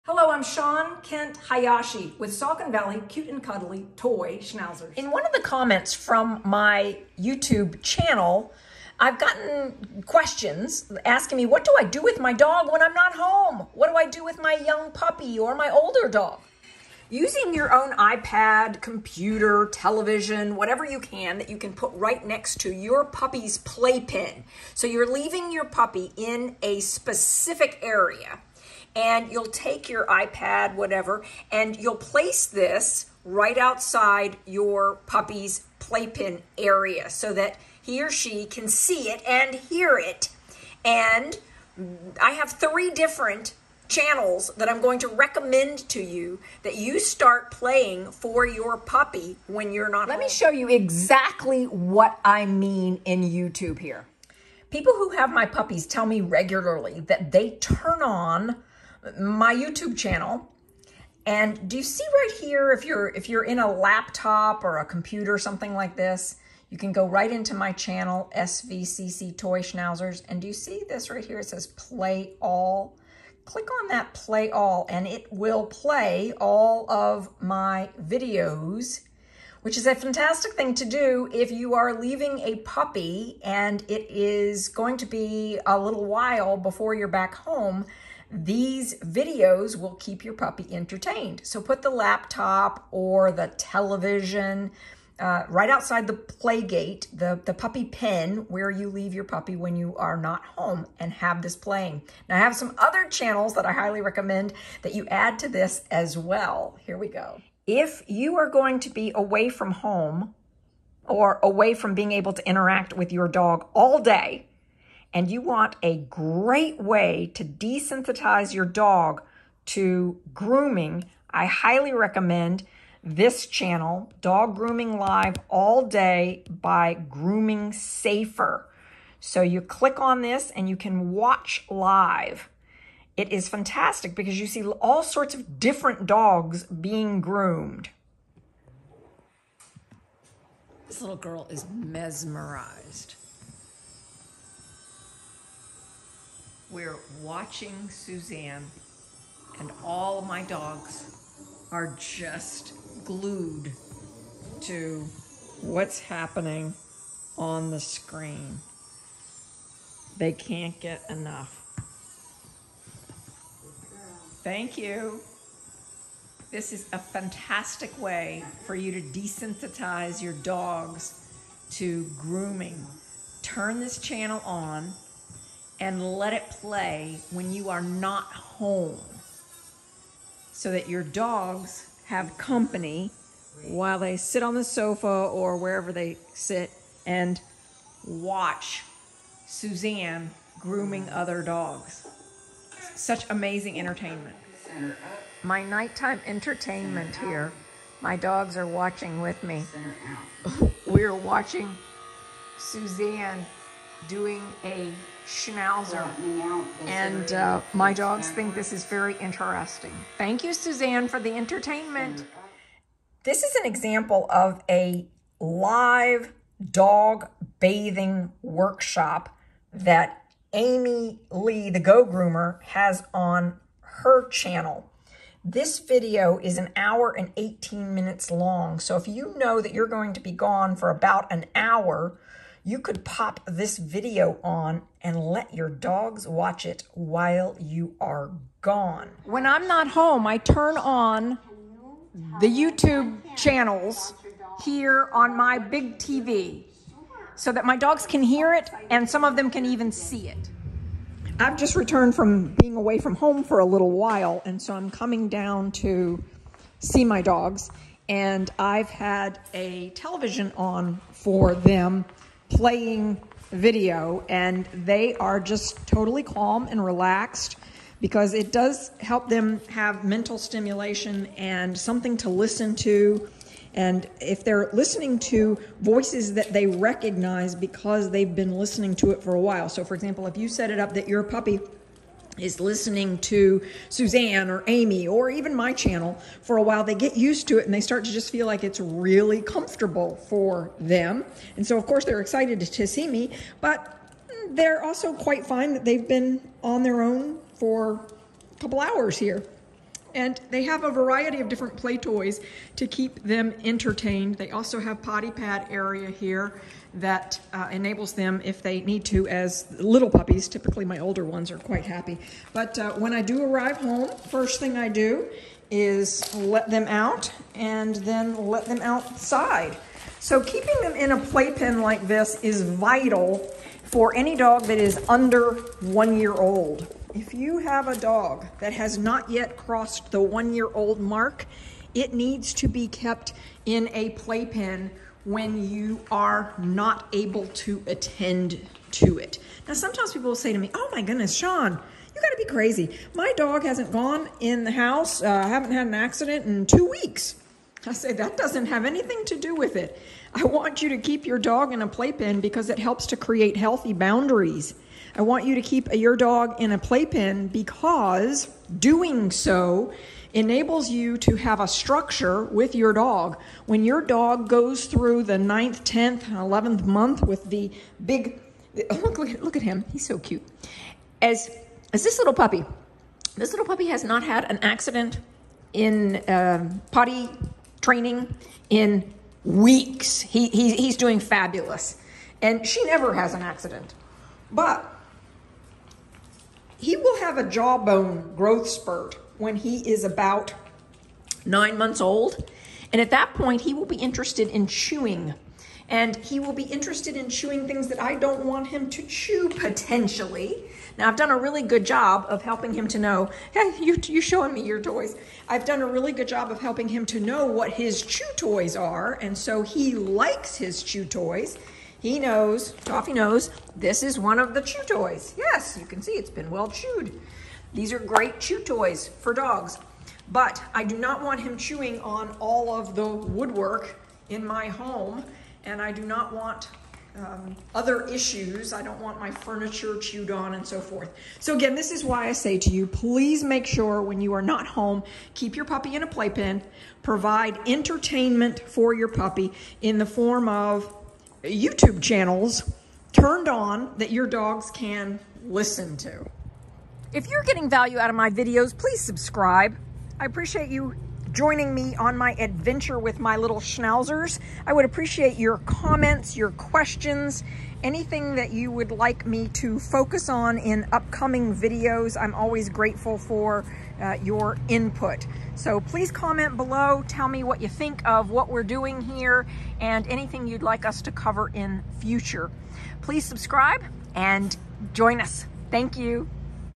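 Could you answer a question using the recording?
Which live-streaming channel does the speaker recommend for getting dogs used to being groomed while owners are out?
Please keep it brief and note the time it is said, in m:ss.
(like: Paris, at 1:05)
Dog Grooming Live, at 2:04.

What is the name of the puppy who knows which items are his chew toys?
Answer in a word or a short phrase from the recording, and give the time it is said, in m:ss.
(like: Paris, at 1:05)
Toffee, at 6:52.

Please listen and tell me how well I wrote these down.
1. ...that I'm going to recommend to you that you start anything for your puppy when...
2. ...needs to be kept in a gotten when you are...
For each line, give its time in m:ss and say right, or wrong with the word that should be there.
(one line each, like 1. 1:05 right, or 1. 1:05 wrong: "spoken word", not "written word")
1. 0:44 wrong: "playing", not "anything"
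2. 5:32 wrong: "playpen", not "gotten".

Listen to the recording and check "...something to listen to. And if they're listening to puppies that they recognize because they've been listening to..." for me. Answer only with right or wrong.
wrong.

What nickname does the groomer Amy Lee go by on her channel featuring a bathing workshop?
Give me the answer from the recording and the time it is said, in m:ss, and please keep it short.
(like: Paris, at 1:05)
the Go Groomer, at 3:41.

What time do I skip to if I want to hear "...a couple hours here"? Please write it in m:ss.
4:58.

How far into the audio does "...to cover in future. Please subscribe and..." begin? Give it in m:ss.
7:51.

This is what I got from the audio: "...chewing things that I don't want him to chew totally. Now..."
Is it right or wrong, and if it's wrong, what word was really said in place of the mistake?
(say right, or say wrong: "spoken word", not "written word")
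wrong: "potentially", not "totally".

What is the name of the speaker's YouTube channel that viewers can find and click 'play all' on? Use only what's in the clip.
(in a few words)
SVCC Toy Schnauzers.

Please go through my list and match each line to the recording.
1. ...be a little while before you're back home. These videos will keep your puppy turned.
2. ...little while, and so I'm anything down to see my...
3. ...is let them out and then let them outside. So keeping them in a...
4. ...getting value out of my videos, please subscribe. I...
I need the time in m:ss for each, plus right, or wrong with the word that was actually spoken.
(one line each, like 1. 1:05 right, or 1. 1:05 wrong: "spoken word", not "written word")
1. 1:25 wrong: "entertained", not "turned"
2. 4:13 wrong: "coming", not "anything"
3. 5:15 right
4. 7:27 right.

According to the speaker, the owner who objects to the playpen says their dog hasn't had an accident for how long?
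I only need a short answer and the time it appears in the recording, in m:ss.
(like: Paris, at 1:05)
2 weeks, at 5:46.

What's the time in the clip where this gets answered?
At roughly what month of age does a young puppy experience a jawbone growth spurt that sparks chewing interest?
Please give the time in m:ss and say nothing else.
6:31.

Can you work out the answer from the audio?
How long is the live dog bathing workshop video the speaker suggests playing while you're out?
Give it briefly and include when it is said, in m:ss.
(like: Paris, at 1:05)
1 hour 18 minutes, at 3:46.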